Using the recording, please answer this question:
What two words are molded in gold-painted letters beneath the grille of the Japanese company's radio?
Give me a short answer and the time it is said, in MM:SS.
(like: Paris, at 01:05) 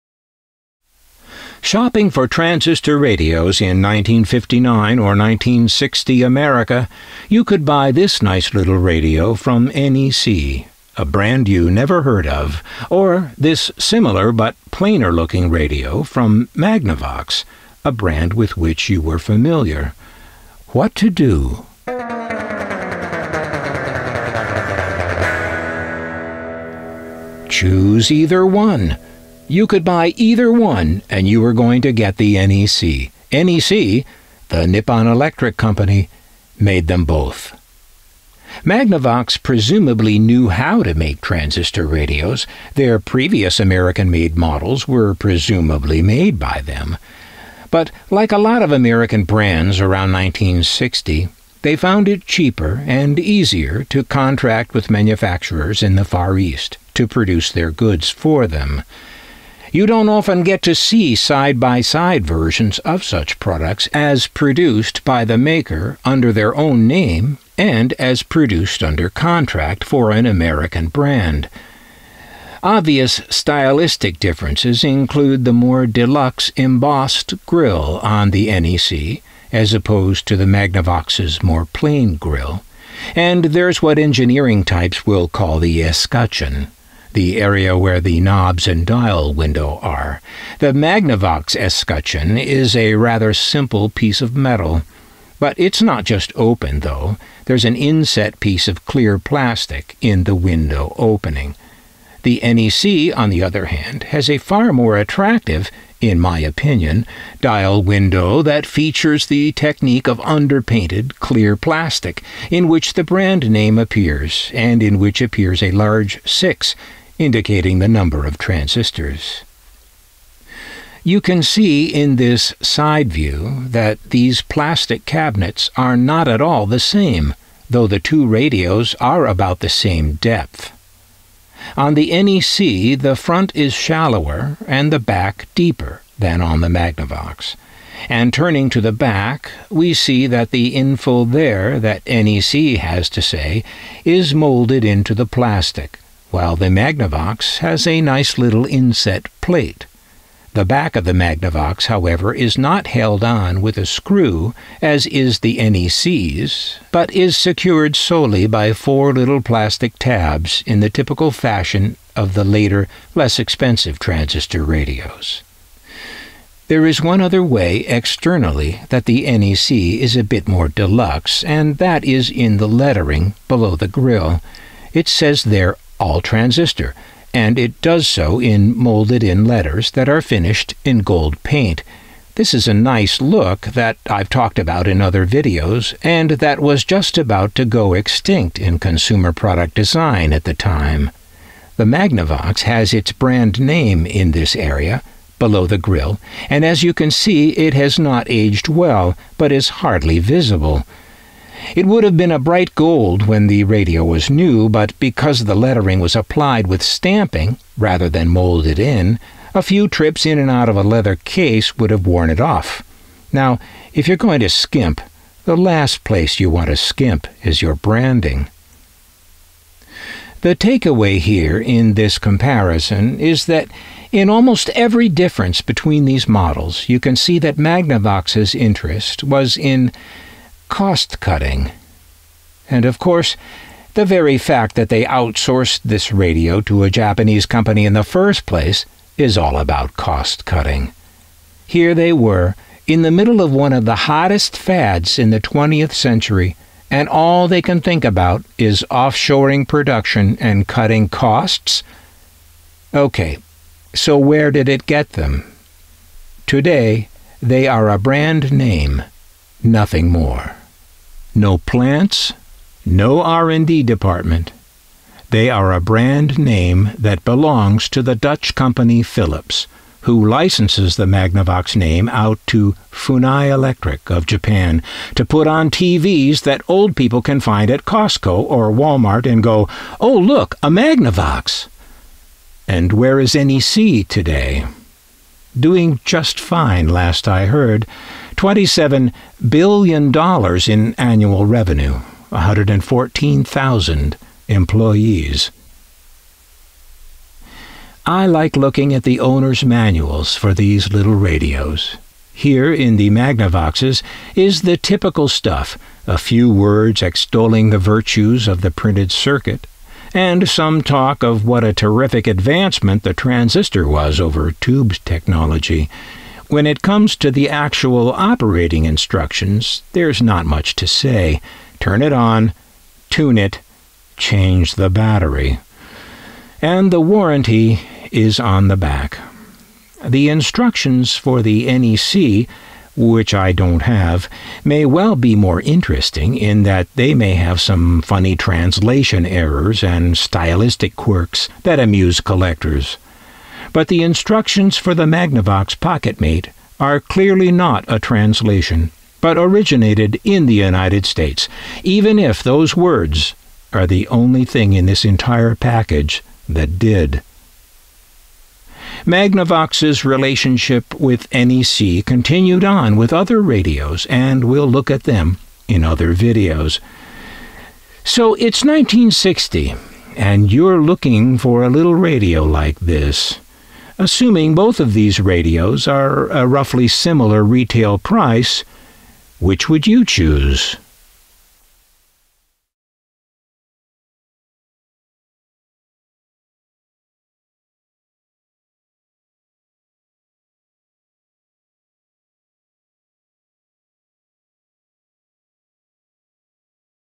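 All transistor, at 02:56.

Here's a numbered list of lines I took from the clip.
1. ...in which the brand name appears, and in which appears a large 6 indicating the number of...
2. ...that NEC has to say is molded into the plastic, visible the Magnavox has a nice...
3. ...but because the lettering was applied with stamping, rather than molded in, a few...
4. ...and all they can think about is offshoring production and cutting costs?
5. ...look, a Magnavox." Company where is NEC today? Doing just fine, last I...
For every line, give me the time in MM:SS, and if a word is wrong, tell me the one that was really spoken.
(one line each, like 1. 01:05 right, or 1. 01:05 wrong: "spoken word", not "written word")
1. 01:52 right
2. 02:21 wrong: "while", not "visible"
3. 03:24 right
4. 04:06 right
5. 04:40 wrong: "And", not "Company".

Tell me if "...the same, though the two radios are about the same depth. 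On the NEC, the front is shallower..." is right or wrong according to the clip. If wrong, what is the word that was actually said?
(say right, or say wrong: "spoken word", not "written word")
right.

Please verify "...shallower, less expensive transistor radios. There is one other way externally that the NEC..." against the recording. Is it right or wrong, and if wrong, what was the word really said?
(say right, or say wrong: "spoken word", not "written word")
wrong: "later", not "shallower".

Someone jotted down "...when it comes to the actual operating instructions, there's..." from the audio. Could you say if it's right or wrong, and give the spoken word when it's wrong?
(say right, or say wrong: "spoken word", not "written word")
right.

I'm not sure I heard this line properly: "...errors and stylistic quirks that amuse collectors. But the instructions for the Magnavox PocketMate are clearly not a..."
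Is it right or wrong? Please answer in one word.
right.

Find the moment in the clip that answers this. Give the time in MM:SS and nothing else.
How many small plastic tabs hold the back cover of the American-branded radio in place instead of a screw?
02:38.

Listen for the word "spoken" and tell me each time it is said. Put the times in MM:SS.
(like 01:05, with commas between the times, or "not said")
not said.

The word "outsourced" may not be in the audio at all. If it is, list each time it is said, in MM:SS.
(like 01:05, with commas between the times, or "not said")
03:55.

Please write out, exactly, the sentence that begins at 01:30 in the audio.
The Magnavox escutcheon is a rather simple piece of metal.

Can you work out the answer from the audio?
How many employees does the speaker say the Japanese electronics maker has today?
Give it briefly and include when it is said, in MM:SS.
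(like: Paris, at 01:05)
114,000, at 04:52.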